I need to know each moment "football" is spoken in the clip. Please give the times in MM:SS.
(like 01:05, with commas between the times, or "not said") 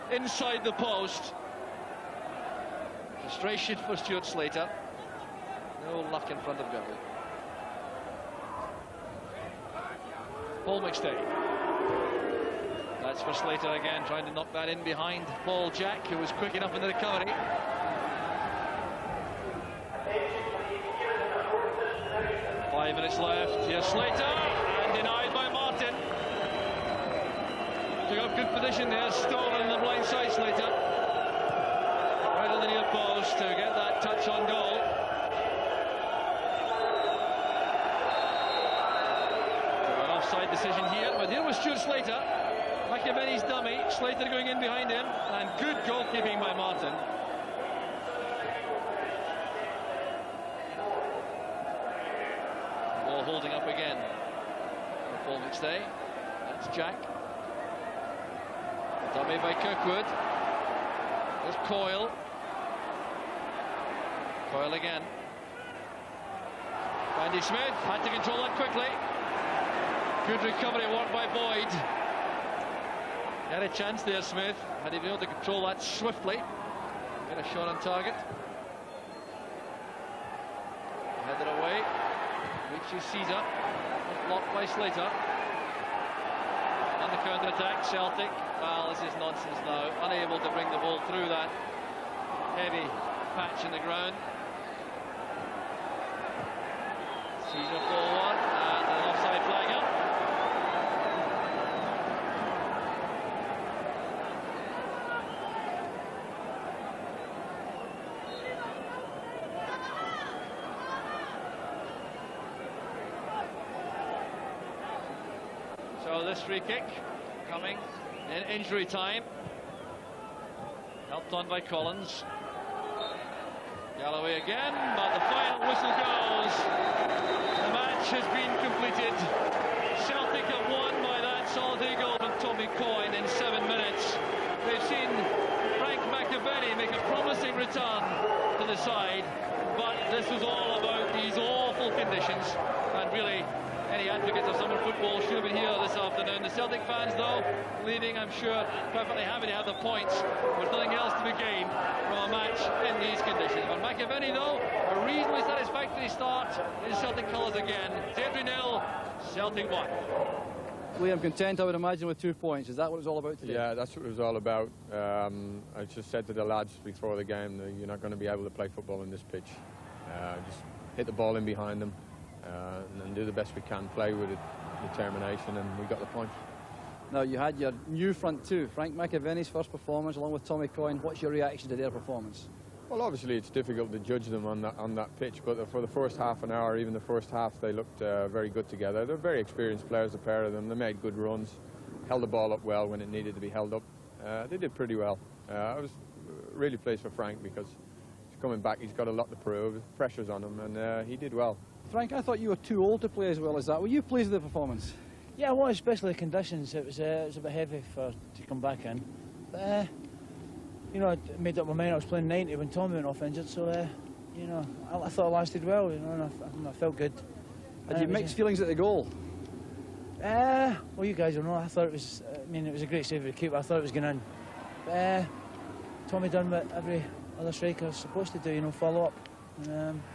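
02:24, 02:48.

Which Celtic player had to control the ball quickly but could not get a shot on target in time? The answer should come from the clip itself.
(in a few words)
Randy Smith.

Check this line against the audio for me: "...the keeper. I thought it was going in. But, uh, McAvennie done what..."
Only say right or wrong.
wrong.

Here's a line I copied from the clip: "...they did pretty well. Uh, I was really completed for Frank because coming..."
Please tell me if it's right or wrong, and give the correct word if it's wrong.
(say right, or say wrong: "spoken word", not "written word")
wrong: "pleased", not "completed".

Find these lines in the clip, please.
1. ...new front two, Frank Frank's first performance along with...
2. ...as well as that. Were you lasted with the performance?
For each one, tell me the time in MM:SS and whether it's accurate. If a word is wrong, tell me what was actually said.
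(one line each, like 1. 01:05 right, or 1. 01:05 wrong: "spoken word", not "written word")
1. 02:57 wrong: "McAvennie", not "Frank"
2. 03:23 wrong: "pleased", not "lasted".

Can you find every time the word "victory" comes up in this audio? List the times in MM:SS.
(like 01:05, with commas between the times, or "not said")
not said.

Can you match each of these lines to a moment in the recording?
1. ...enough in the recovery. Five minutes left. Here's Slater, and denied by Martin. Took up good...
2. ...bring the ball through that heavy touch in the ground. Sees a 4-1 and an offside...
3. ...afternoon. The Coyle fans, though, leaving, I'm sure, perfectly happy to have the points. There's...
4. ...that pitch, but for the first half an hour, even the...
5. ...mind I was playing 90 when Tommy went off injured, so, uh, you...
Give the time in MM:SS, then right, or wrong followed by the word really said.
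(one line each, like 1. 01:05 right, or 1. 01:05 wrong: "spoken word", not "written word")
1. 00:16 right
2. 01:30 wrong: "patch", not "touch"
3. 02:25 wrong: "Celtic", not "Coyle"
4. 03:04 right
5. 03:31 right.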